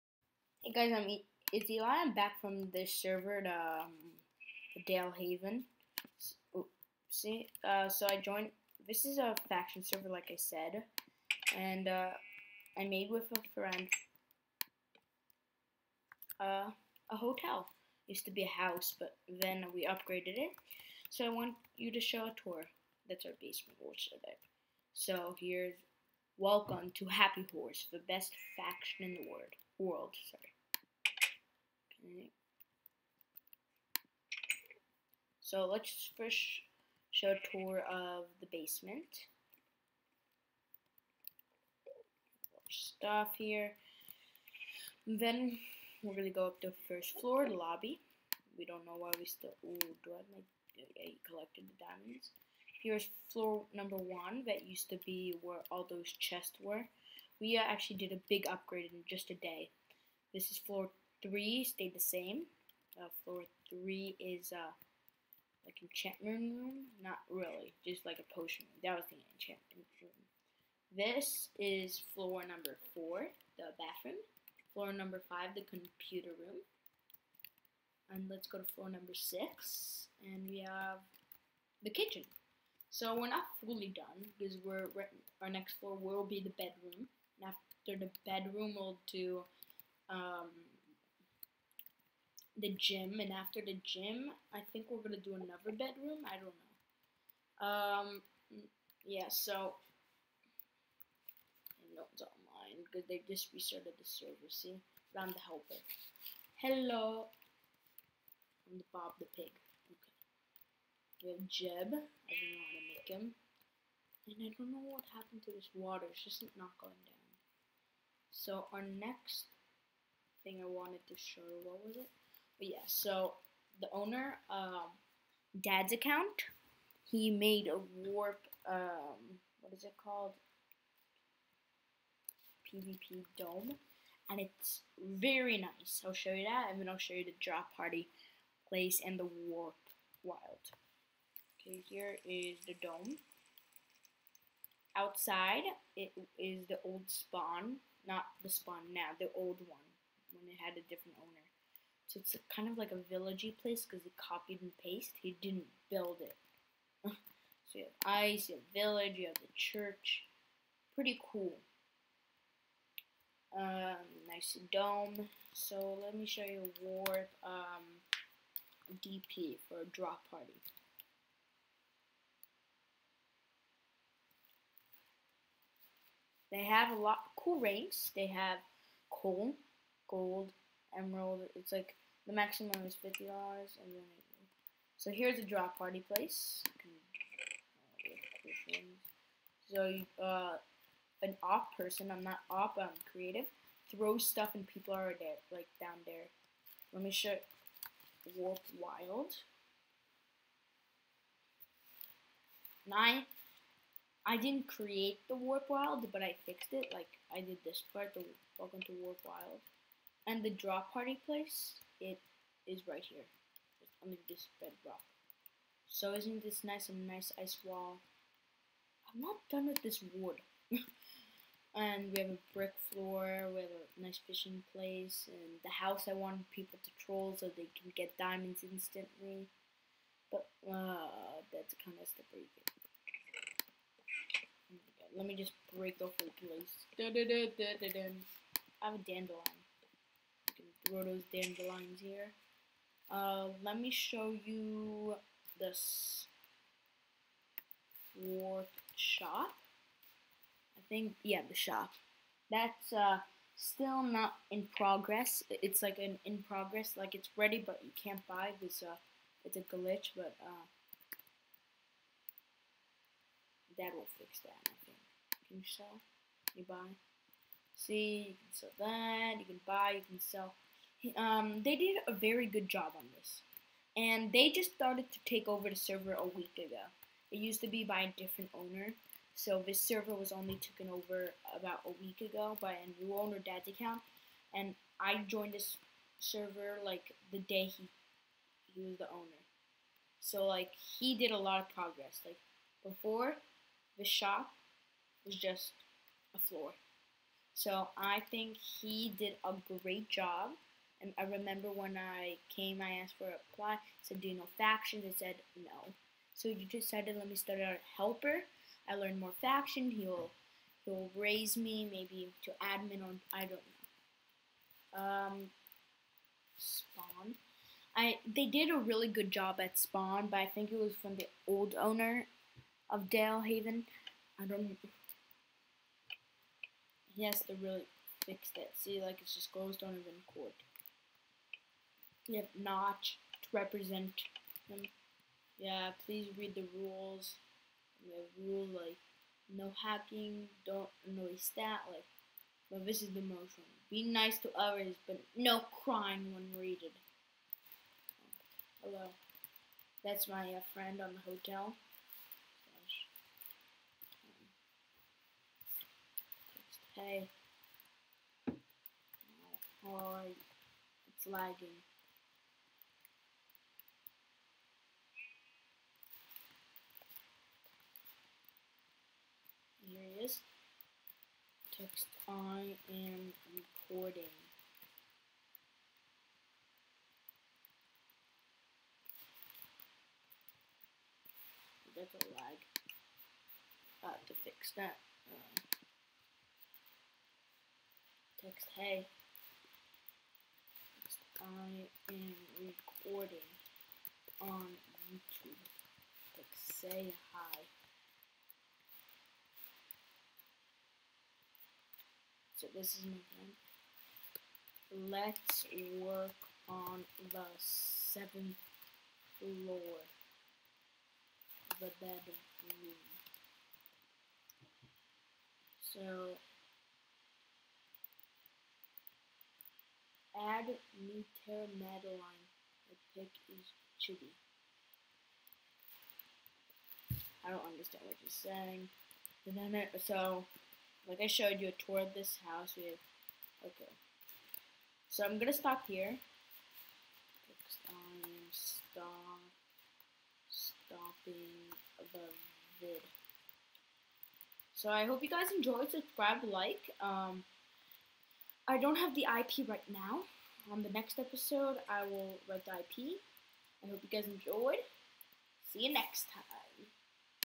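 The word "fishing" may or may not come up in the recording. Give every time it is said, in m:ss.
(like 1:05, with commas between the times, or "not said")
3:44.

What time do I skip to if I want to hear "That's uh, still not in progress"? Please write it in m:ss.
4:12.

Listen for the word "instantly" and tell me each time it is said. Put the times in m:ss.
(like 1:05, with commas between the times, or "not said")
3:48.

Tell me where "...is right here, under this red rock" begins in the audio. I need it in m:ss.
3:32.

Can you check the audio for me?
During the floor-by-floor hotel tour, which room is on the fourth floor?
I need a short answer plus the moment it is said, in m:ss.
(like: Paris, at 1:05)
Bathroom, at 1:13.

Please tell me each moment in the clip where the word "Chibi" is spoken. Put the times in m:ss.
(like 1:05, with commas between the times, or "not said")
7:03.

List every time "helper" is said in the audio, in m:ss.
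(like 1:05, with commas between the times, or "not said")
1:45, 5:07.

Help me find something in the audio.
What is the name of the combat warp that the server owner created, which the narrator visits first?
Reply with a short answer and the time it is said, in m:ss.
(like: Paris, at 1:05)
PvP dome, at 2:12.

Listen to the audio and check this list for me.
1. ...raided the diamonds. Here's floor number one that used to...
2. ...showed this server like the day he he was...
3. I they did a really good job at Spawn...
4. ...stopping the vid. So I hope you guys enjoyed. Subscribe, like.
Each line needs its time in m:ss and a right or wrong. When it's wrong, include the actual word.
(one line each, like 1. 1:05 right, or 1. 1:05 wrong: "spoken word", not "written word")
1. 0:51 wrong: "collected", not "raided"
2. 4:45 wrong: "joined", not "showed"
3. 5:17 right
4. 7:20 right.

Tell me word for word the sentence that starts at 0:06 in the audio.
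So, oops, oh, see, uh, so I joined.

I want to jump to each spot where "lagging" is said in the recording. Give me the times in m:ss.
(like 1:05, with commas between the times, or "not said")
6:01.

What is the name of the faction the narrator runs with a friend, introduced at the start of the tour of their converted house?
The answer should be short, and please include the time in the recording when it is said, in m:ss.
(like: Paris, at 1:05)
Happy Horse, at 0:27.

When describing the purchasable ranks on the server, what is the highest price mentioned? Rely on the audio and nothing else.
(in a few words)
50 dollars.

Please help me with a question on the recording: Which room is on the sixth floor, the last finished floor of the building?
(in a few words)
Kitchen.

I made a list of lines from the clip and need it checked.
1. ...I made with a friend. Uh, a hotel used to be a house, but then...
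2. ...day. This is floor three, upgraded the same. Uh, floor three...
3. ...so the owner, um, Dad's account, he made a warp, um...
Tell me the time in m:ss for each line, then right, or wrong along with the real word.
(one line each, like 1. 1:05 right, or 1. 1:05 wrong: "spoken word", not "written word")
1. 0:12 right
2. 0:59 wrong: "stayed", not "upgraded"
3. 2:02 right.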